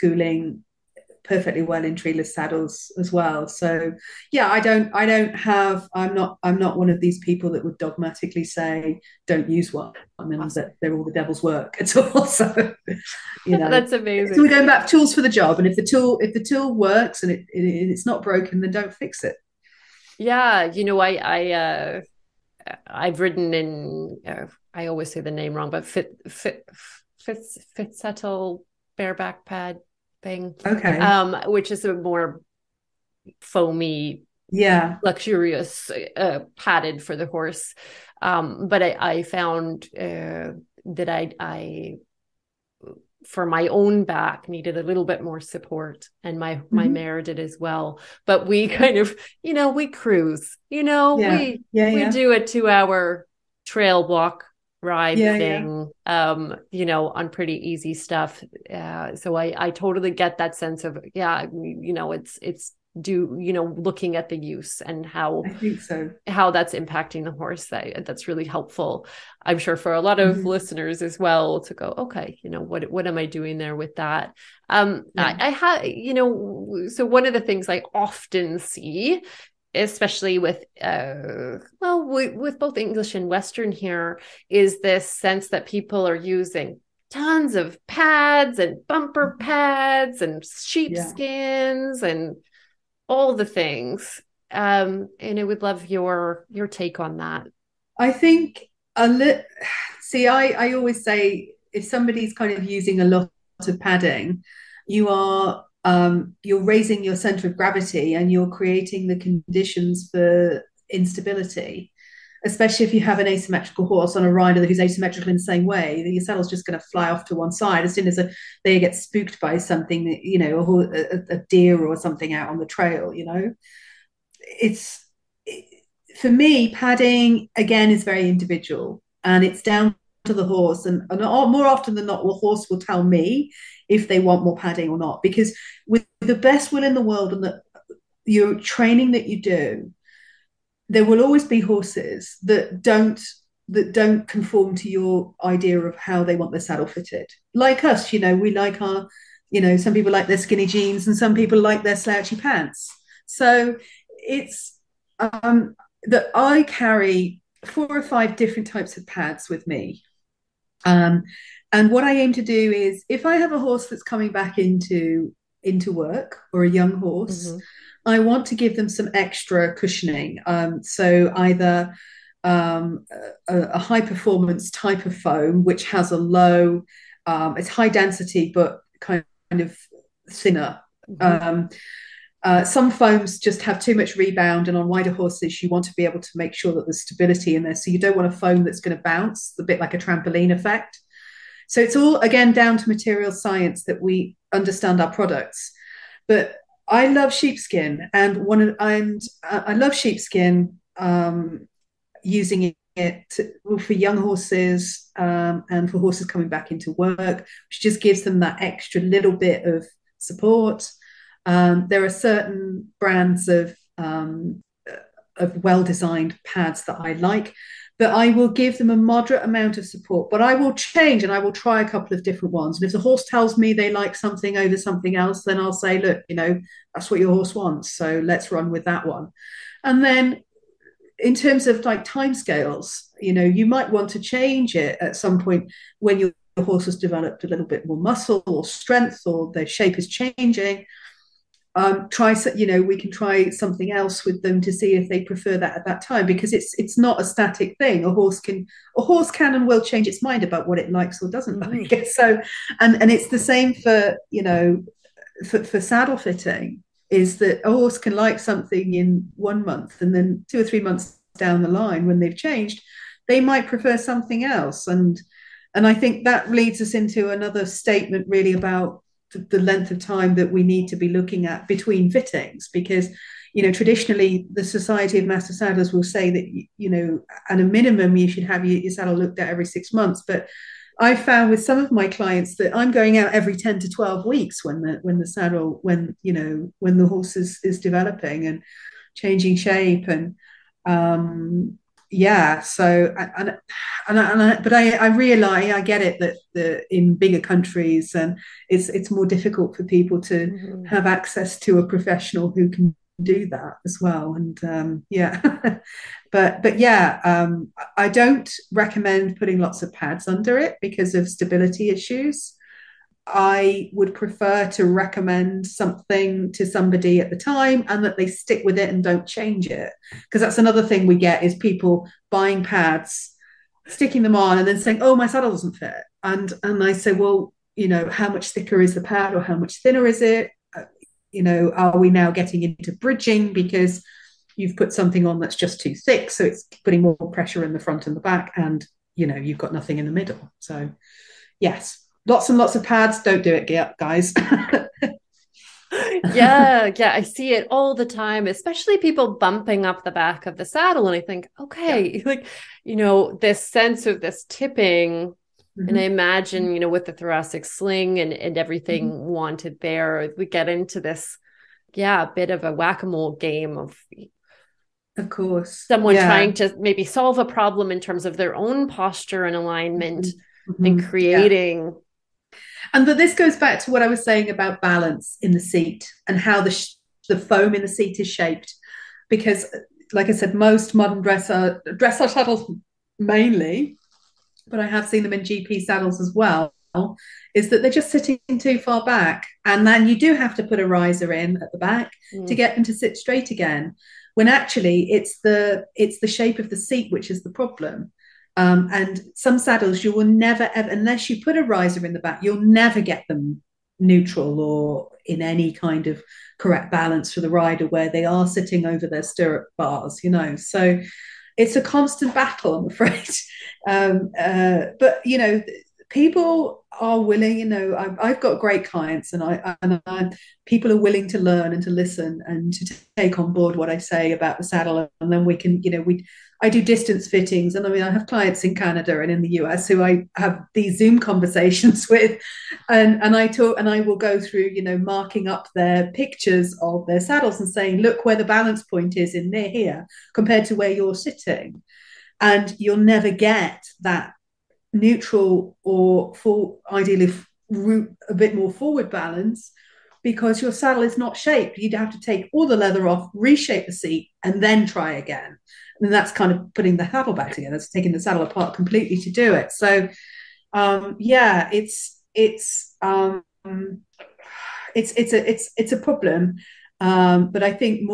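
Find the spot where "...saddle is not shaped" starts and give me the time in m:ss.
7:30.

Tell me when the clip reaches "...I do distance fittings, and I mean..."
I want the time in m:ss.
7:06.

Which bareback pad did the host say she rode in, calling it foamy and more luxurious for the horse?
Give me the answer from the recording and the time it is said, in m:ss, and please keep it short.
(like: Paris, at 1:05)
Fit settle bareback pad, at 0:27.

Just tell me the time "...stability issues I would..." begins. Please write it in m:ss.
5:11.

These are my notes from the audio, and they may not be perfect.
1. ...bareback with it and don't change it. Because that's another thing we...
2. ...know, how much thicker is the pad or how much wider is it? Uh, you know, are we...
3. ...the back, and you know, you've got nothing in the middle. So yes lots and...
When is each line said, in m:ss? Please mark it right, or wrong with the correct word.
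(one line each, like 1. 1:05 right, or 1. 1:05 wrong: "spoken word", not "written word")
1. 5:18 wrong: "stick", not "bareback"
2. 5:27 wrong: "thinner", not "wider"
3. 5:38 right.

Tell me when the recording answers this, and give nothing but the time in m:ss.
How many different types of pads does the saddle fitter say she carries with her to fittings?
2:37.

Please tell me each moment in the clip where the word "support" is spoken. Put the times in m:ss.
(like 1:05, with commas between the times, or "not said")
0:45, 3:30, 3:39.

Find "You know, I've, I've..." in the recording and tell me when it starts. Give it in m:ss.
6:57.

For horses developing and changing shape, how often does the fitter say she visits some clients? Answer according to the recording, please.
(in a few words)
every 10 to 12 weeks.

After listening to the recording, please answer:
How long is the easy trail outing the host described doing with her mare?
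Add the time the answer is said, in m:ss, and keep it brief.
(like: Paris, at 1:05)
2 hour, at 0:52.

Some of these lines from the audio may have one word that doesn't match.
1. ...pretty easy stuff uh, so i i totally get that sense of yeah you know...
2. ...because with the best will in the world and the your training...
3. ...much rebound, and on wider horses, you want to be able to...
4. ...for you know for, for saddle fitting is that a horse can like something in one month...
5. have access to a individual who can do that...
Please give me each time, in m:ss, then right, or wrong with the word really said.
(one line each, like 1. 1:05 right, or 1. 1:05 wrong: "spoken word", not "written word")
1. 0:57 right
2. 2:15 right
3. 3:03 right
4. 4:13 right
5. 5:00 wrong: "professional", not "individual".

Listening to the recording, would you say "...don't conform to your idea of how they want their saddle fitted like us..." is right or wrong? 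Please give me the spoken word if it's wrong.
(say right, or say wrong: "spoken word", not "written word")
right.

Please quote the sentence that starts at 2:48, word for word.
I want to give them some extra cushioning.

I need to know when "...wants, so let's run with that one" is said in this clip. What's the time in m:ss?
3:47.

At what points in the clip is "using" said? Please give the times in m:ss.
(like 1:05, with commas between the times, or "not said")
1:26, 1:42, 3:22.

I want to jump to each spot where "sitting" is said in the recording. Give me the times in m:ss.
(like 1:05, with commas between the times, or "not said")
6:28, 6:48, 7:21.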